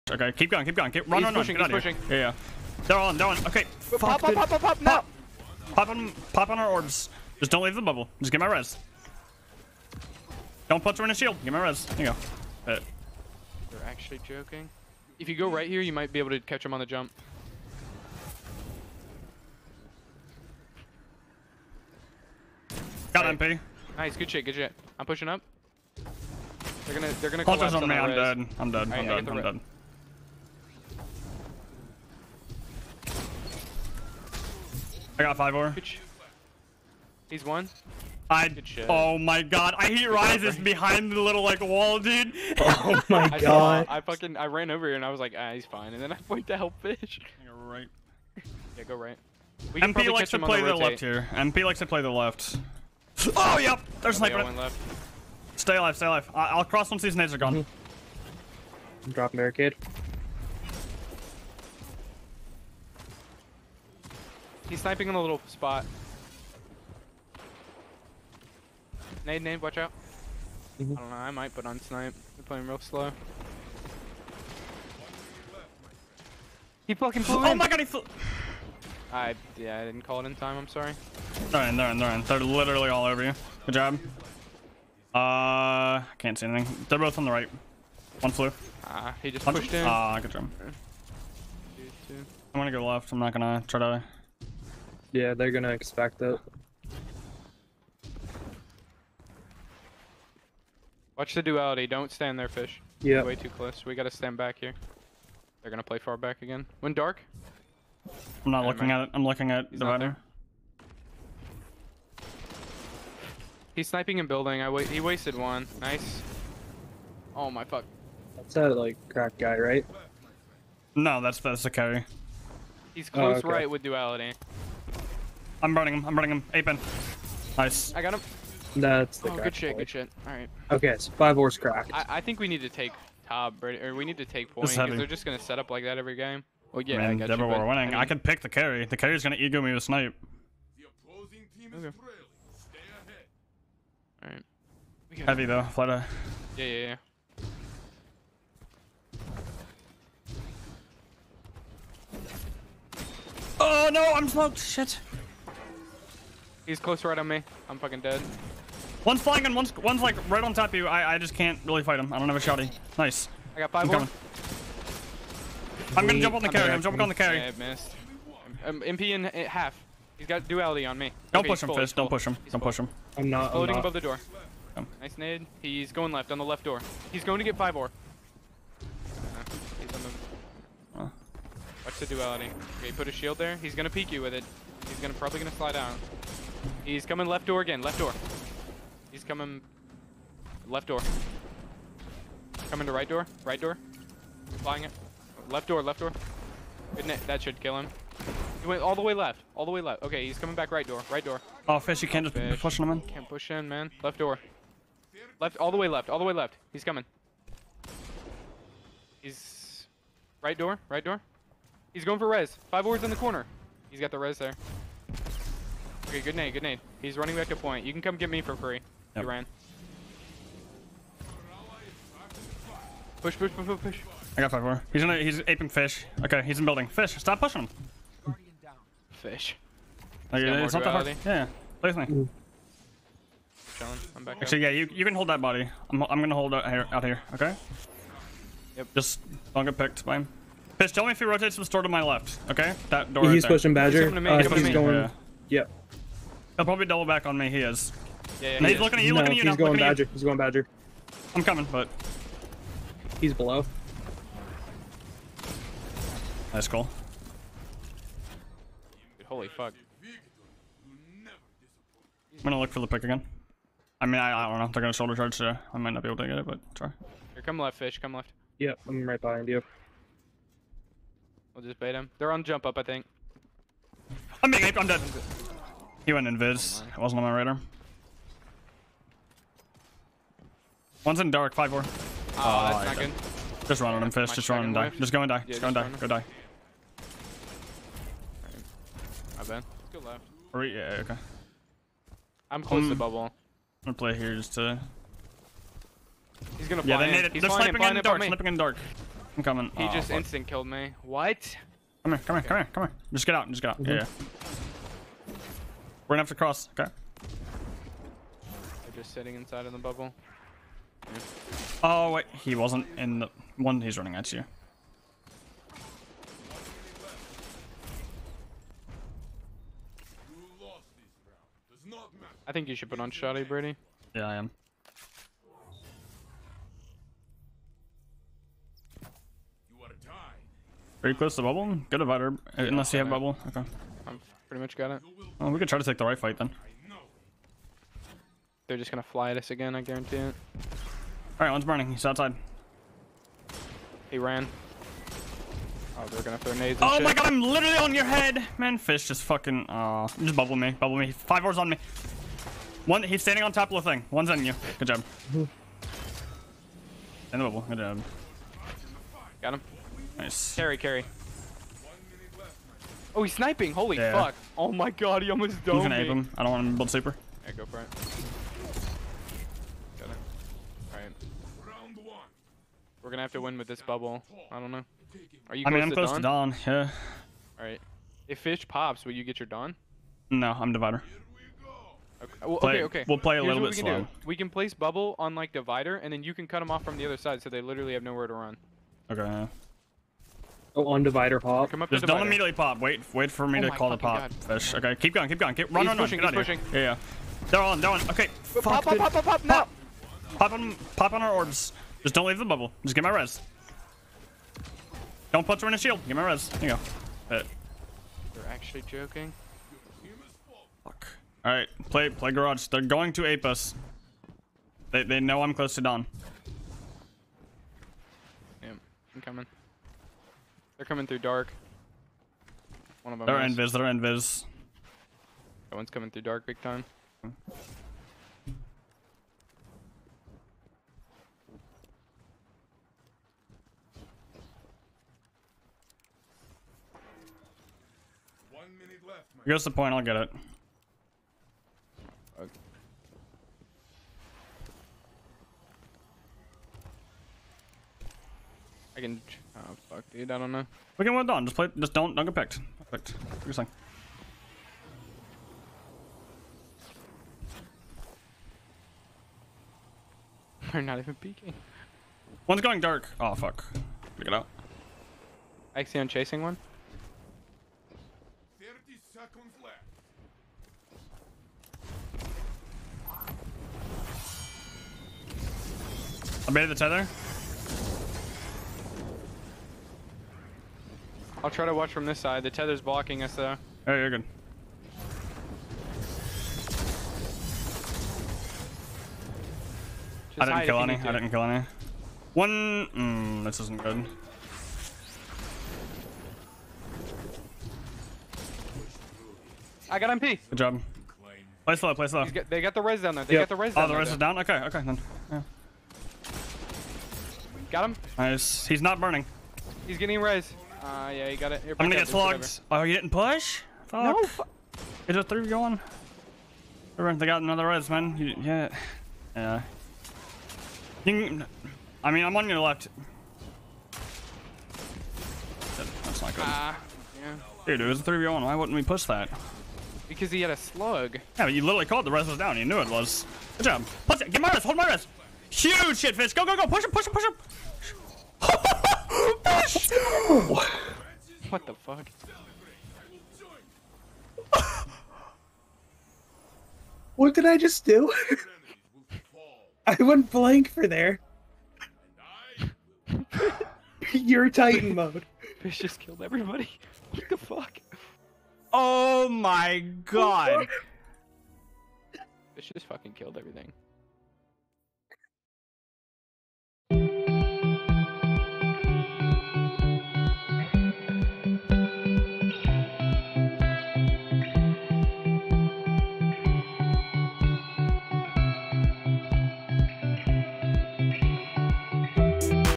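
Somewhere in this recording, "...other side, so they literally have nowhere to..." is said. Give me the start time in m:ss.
6:27.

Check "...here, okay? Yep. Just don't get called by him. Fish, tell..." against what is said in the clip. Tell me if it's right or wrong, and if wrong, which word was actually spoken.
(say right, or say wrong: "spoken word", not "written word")
wrong: "picked", not "called".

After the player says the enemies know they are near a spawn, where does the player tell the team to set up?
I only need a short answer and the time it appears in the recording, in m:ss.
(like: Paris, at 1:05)
garage, at 6:52.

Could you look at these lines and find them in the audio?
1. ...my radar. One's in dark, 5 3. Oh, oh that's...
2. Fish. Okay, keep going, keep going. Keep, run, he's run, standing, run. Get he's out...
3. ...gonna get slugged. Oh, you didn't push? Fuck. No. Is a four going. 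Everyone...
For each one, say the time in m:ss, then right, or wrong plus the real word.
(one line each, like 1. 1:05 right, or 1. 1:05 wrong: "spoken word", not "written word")
1. 4:37 wrong: "4", not "3"
2. 6:34 wrong: "pushing", not "standing"
3. 8:31 wrong: "three", not "four".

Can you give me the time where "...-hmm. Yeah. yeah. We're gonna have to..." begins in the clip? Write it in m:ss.
5:03.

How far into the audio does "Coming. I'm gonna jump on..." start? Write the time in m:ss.
2:43.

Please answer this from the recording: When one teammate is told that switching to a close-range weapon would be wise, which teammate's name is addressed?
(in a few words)
Brady.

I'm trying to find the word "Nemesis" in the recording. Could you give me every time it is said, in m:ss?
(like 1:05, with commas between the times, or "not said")
not said.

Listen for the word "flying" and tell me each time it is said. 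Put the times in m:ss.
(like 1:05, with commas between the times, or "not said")
2:39, 3:14.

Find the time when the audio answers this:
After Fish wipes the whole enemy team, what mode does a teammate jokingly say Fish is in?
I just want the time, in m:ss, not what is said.
9:14.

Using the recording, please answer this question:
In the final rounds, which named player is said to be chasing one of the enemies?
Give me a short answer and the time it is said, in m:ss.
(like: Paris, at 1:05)
Axion, at 7:45.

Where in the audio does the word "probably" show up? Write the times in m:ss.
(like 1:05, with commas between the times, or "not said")
3:05, 4:06.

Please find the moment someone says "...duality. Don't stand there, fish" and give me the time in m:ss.
1:41.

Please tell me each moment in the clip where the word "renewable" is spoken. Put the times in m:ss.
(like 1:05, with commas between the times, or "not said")
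not said.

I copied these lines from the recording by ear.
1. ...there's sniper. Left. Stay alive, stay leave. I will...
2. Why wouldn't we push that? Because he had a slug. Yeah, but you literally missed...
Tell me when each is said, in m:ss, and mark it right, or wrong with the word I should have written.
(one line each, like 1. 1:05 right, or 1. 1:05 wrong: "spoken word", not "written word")
1. 0:54 wrong: "alive", not "leave"
2. 8:48 wrong: "called", not "missed".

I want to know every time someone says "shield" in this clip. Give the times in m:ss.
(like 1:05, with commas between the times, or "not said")
0:11, 3:03, 6:45.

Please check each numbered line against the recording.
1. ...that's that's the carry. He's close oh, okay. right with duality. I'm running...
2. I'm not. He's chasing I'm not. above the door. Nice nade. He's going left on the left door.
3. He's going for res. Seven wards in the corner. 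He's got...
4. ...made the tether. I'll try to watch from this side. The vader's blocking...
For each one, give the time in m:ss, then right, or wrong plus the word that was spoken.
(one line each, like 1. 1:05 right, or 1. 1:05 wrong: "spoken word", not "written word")
1. 2:01 right
2. 2:53 wrong: "floating", not "chasing"
3. 3:31 wrong: "Five", not "Seven"
4. 7:56 wrong: "tether", not "vader".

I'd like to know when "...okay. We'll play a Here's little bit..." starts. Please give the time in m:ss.
6:22.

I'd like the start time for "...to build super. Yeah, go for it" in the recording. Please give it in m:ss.
6:06.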